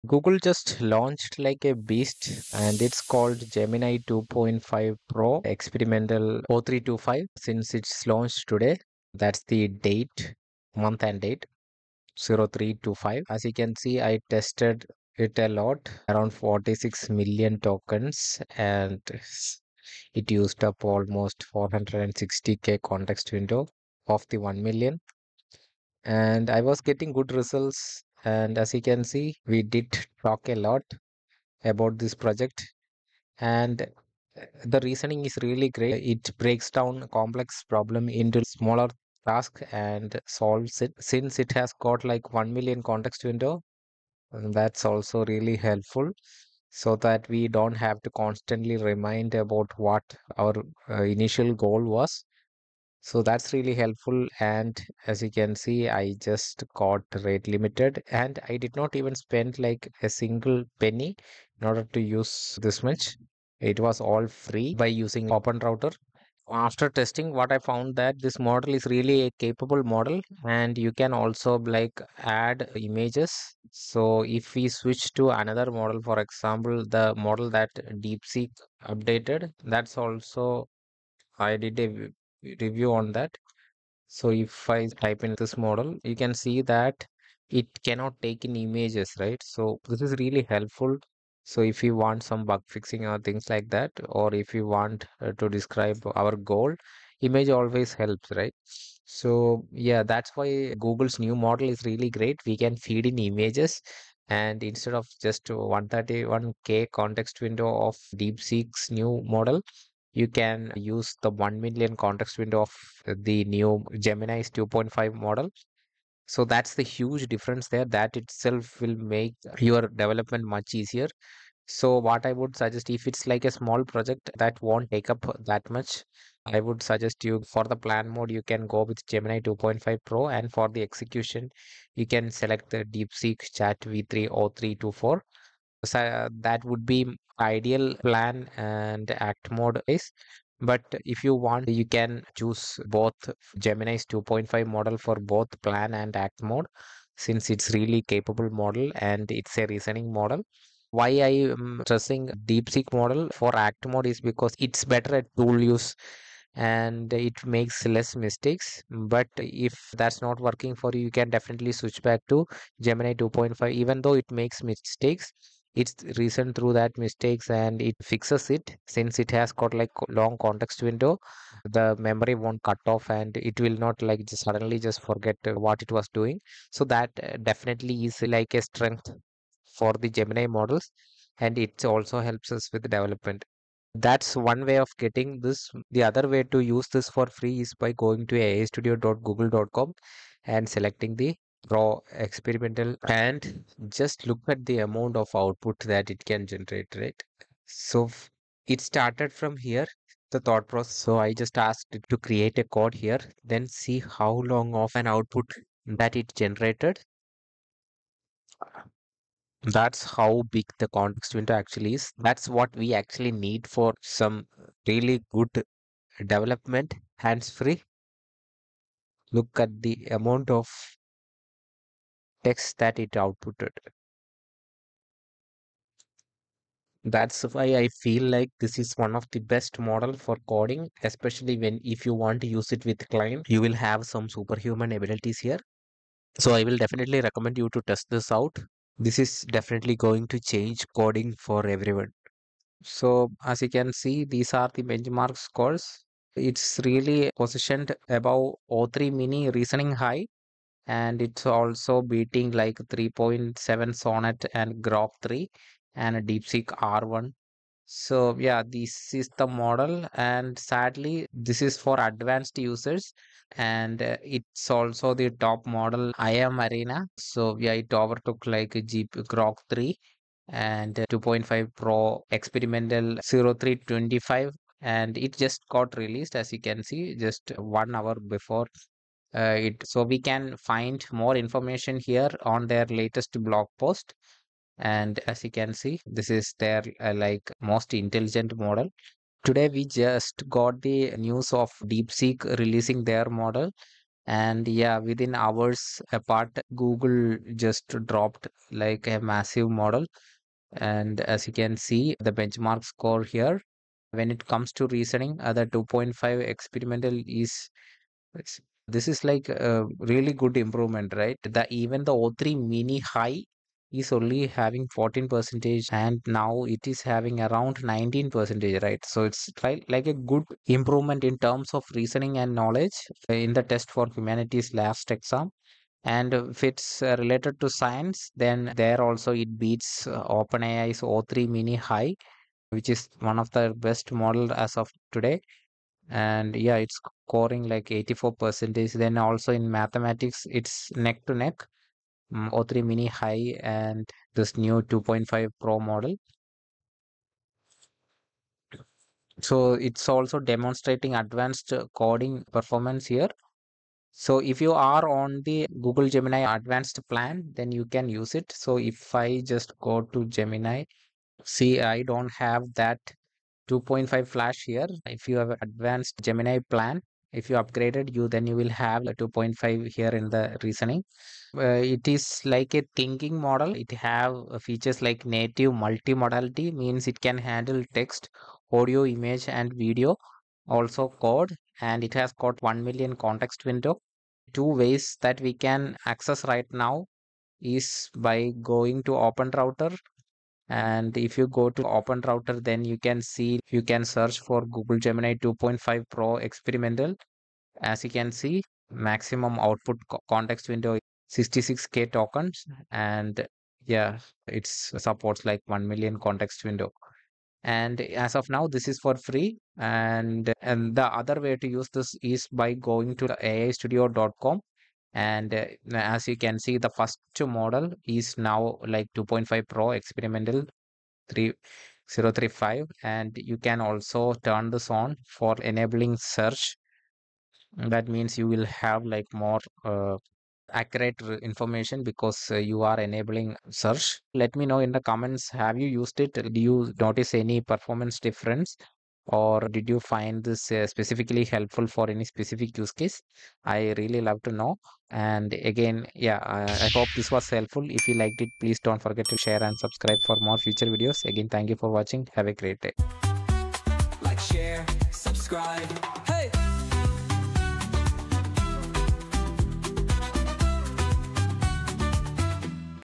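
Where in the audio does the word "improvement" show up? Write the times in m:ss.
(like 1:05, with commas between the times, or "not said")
5:10, 5:20.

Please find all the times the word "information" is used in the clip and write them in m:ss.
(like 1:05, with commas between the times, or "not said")
4:41, 7:11.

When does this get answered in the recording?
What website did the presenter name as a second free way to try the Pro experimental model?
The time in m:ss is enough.
3:08.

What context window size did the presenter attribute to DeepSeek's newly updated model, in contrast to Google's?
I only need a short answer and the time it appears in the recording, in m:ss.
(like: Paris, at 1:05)
131k, at 1:45.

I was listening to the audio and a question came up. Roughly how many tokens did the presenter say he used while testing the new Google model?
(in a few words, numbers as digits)
46 million.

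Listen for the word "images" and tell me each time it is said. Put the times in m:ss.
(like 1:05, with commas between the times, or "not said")
1:12, 1:28, 1:37, 1:43, 6:19.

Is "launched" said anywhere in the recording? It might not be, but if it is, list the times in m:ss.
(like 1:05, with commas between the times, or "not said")
0:00, 0:08.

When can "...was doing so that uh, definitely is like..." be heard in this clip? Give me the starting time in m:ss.
2:55.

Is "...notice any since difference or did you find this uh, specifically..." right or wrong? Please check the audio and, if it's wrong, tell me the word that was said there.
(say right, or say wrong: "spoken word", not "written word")
wrong: "performance", not "since".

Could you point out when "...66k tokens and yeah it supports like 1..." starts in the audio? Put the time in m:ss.
6:41.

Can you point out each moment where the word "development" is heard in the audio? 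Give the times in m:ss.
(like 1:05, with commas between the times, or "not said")
1:59, 3:02, 3:36.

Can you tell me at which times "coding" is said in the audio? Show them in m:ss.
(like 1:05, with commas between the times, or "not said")
3:50, 4:00, 5:51.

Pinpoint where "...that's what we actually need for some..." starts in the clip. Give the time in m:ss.
3:32.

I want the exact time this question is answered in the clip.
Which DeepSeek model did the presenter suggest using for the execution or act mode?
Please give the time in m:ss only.
2:12.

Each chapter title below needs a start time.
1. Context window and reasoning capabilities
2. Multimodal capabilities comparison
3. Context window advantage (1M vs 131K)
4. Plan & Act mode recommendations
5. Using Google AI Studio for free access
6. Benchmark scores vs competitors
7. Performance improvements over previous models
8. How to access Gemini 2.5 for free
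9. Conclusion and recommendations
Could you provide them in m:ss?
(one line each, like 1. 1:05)
1. 0:30
2. 1:10
3. 1:45
4. 2:25
5. 3:15
6. 3:55
7. 4:50
8. 5:55
9. 7:15.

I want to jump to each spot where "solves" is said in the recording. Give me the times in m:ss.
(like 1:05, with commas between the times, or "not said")
0:40.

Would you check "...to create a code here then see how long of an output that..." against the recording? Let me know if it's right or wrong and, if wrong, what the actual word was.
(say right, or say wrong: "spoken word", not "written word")
right.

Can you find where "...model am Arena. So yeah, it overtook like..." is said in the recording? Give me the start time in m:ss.
4:25.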